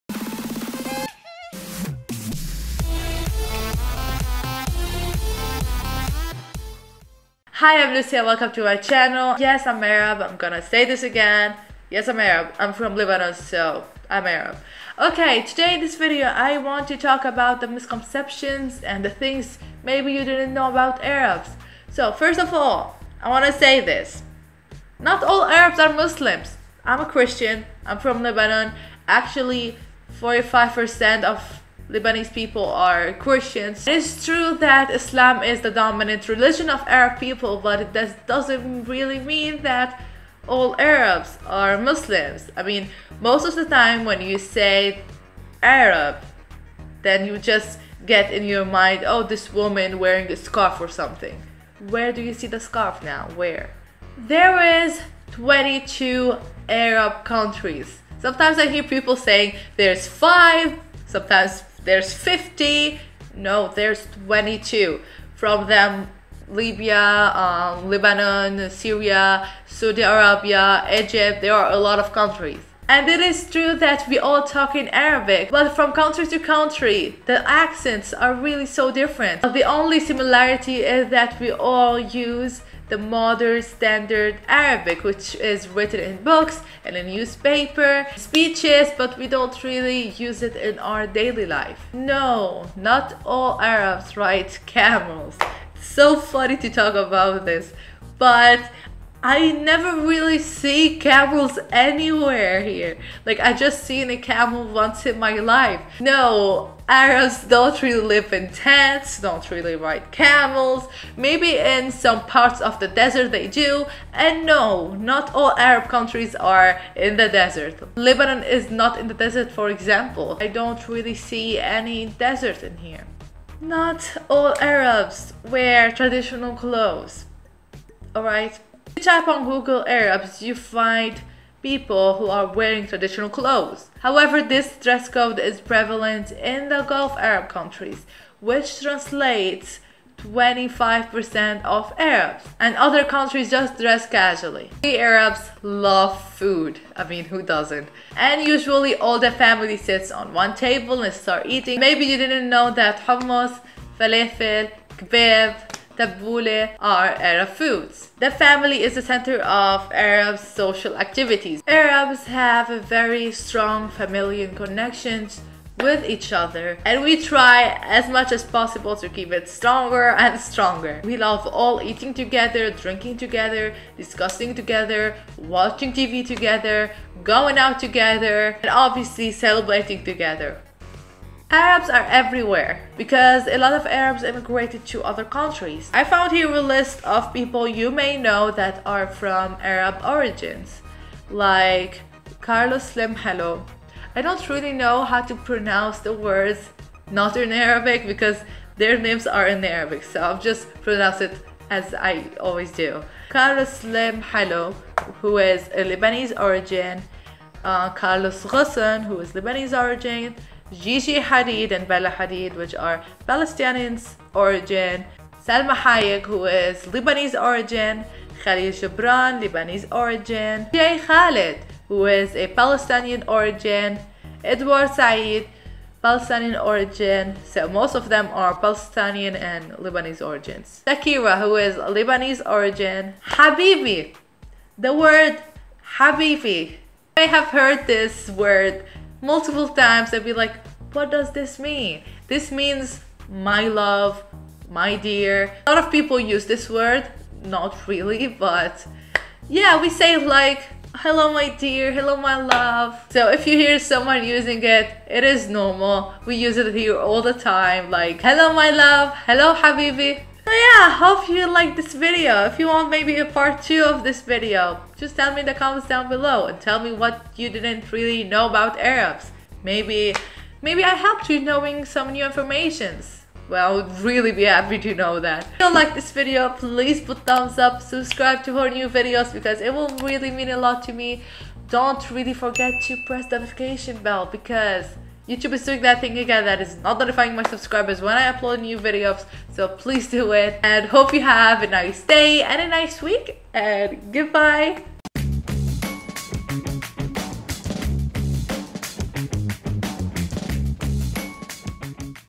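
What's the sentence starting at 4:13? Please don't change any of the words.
So if you hear someone using it, it is normal.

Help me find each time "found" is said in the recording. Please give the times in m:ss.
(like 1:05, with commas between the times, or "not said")
3:06.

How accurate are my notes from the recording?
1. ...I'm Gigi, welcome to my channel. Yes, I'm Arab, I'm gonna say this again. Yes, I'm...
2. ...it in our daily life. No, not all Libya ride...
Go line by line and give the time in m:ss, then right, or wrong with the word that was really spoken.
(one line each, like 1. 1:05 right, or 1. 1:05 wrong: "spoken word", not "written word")
1. 0:07 wrong: "Lucia", not "Gigi"
2. 1:30 wrong: "Arabs", not "Libya".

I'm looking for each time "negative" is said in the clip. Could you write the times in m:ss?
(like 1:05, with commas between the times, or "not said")
not said.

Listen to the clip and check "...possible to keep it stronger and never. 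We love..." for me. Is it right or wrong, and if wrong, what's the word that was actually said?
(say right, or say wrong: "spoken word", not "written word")
wrong: "stronger", not "never".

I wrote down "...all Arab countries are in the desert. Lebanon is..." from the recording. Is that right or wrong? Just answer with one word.
right.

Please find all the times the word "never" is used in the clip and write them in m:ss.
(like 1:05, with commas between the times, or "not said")
1:39.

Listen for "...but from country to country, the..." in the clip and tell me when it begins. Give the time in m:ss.
1:15.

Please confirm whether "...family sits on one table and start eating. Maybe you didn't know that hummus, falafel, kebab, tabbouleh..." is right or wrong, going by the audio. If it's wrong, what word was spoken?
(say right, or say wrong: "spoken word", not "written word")
right.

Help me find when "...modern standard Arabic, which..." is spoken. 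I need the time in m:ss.
1:22.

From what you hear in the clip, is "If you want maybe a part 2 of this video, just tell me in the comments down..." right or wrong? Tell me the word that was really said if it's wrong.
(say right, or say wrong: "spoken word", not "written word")
right.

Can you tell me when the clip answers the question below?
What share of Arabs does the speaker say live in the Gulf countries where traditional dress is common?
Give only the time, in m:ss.
2:20.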